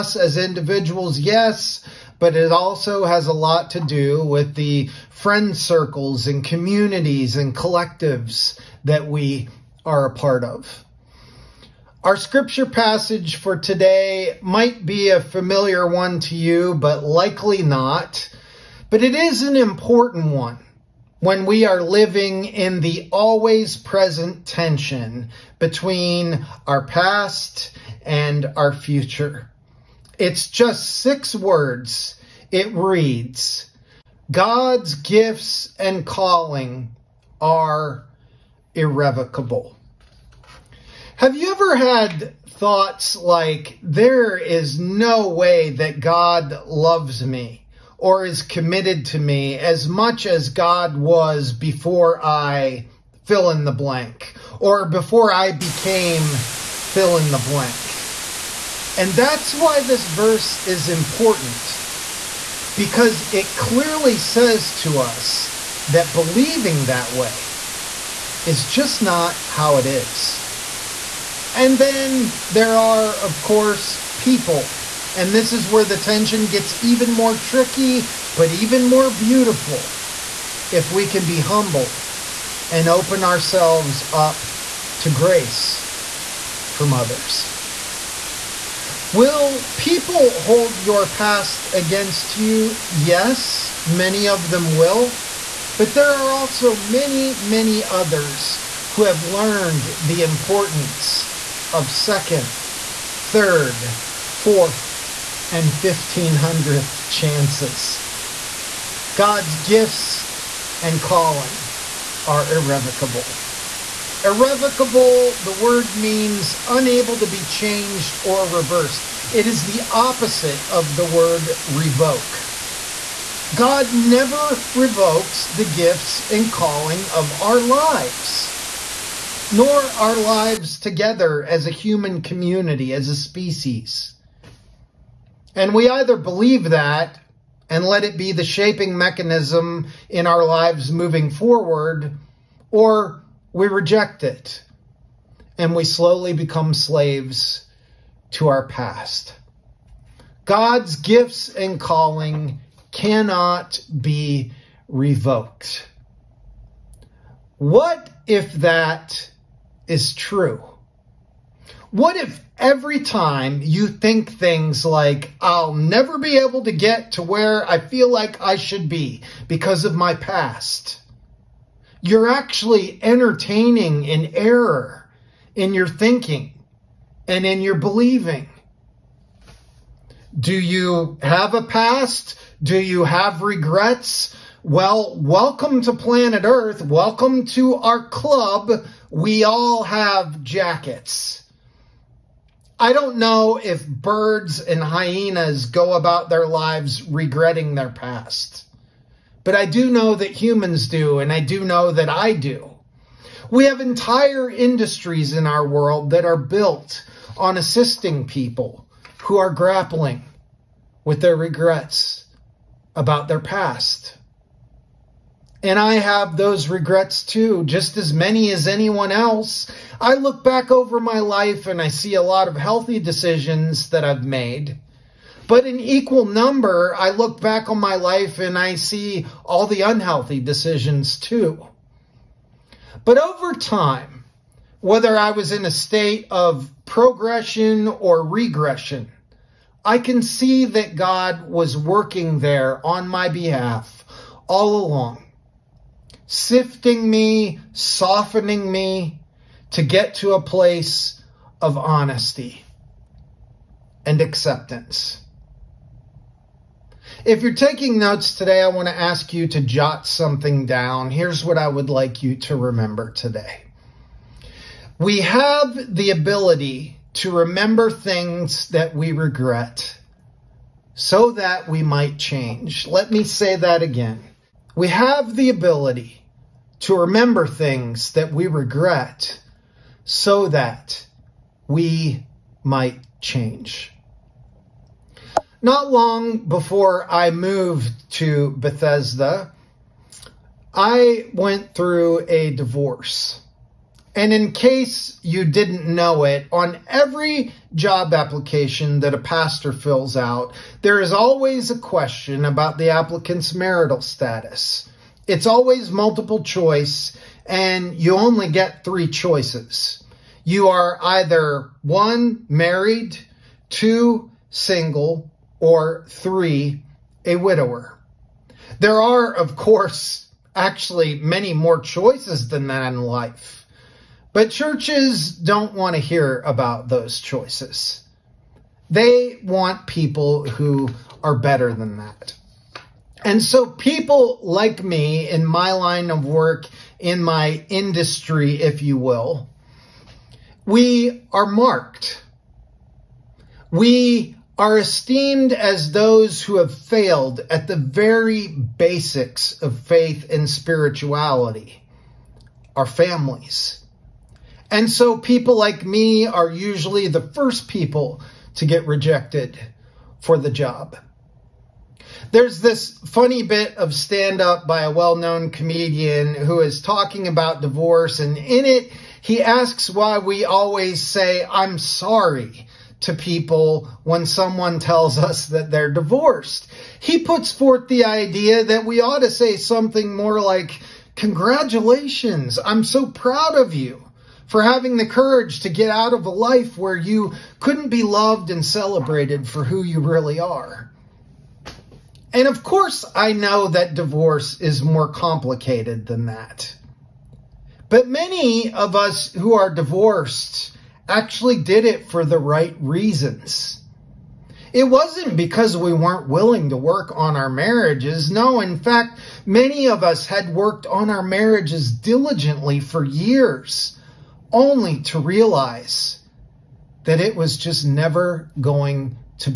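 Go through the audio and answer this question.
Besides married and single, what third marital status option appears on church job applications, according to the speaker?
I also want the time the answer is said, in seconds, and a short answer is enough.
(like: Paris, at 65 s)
Widower, at 317 s.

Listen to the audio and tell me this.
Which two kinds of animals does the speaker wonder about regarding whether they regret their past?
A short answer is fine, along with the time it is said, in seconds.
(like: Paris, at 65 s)
Birds and hyenas, at 193 s.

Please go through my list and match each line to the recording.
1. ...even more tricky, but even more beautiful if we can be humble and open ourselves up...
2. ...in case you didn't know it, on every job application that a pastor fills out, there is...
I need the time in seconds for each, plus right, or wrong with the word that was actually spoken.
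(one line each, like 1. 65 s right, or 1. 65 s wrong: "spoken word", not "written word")
1. 76 s right
2. 294 s right.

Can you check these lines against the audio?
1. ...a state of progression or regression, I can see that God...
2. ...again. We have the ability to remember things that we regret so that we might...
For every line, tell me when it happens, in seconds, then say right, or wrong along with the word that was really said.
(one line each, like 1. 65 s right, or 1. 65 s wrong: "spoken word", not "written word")
1. 235 s right
2. 273 s right.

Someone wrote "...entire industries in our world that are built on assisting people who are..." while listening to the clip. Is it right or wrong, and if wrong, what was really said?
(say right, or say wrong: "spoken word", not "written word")
right.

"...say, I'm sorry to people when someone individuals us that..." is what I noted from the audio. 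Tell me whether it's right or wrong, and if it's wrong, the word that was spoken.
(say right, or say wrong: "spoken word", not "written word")
wrong: "tells", not "individuals".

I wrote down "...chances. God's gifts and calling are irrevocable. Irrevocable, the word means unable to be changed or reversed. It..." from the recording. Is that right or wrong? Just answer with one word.
right.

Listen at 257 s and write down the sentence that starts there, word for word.
If you're taking notes today, I want to ask you to jot something down.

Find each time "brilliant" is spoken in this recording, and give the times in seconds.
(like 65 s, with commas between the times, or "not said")
not said.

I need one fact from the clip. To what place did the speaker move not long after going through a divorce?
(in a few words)
Bethesda.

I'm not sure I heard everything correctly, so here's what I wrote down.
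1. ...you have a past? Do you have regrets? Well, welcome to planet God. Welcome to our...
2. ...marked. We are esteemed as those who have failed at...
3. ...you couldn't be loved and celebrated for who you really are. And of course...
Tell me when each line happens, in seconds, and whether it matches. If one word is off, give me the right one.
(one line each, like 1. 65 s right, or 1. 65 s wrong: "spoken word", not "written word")
1. 180 s wrong: "Earth", not "God"
2. 341 s right
3. 386 s right.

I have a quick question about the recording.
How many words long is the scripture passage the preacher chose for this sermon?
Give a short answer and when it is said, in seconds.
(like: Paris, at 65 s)
6, at 30 s.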